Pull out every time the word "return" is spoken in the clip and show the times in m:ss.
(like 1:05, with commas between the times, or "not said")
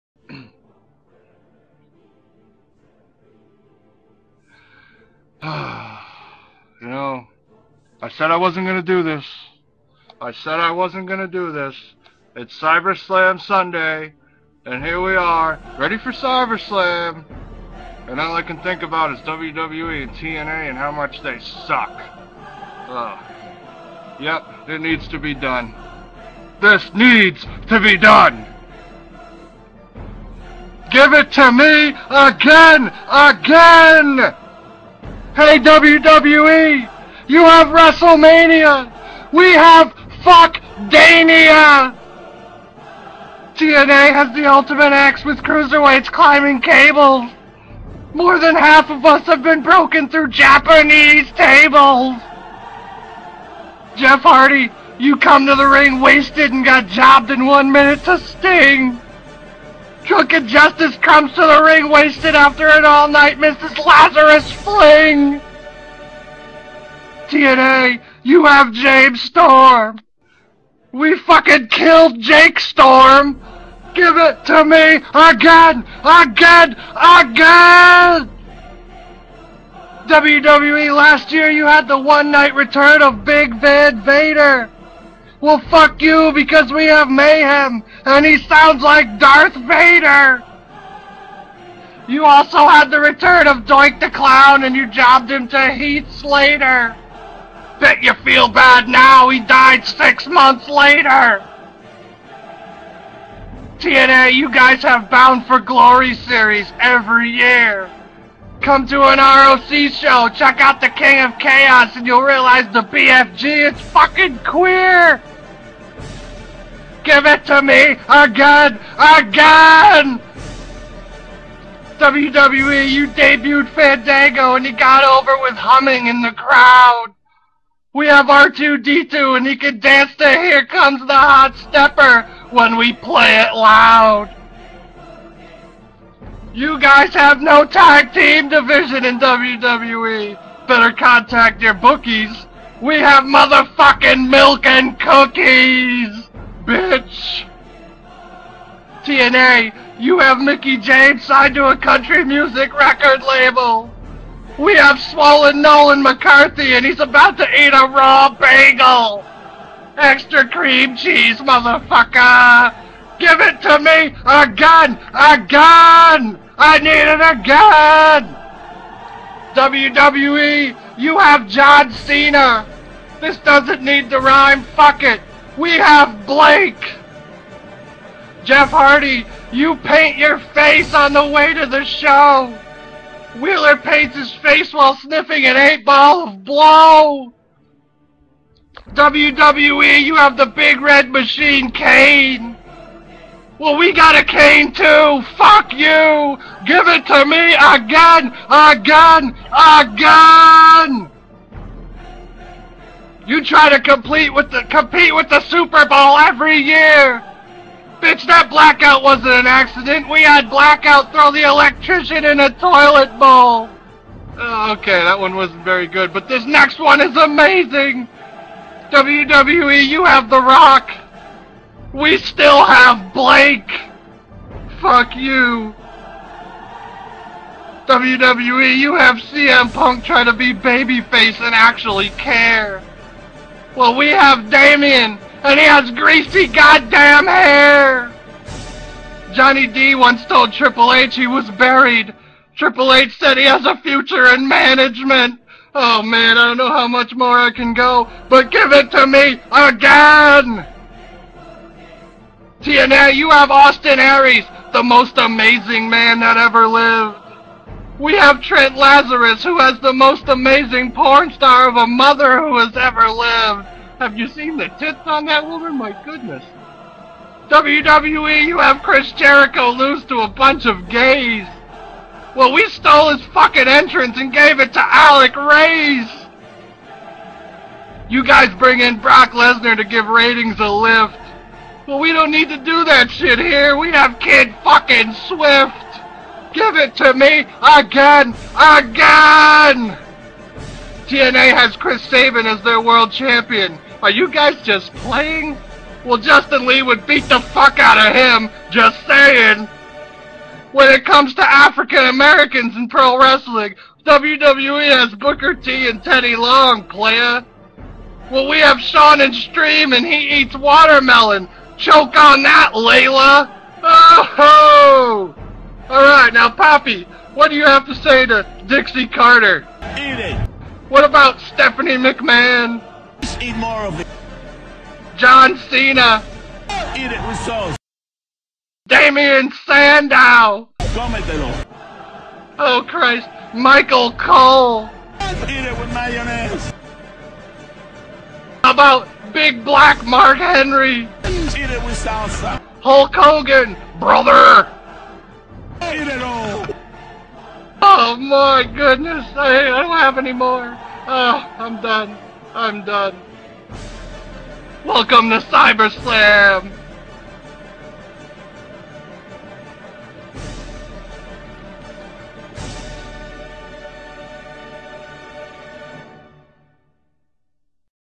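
1:22, 1:32.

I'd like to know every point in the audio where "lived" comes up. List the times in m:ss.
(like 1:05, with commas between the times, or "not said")
4:16, 4:23.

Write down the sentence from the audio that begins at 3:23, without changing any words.
You try to complete with the compete with the Super Bowl every year!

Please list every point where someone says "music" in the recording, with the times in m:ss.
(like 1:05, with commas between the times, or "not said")
2:32.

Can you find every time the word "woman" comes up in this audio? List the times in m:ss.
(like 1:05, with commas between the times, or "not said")
4:25.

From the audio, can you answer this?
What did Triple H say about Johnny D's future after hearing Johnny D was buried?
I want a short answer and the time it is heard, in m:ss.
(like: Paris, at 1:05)
management, at 4:04.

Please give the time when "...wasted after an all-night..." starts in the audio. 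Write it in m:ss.
1:01.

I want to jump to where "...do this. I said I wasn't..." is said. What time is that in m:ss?
0:08.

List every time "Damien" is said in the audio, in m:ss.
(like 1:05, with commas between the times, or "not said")
3:54, 5:28.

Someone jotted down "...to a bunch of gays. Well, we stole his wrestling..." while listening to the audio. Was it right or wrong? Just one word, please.
wrong.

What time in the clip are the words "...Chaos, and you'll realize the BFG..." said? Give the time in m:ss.
1:51.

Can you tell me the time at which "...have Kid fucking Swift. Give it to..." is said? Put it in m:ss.
4:43.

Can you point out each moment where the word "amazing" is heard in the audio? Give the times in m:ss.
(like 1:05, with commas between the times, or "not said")
3:37, 4:15, 4:20.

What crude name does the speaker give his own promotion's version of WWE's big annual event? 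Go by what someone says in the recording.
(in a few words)
Fuck Dania.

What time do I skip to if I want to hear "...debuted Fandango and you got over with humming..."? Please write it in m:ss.
2:03.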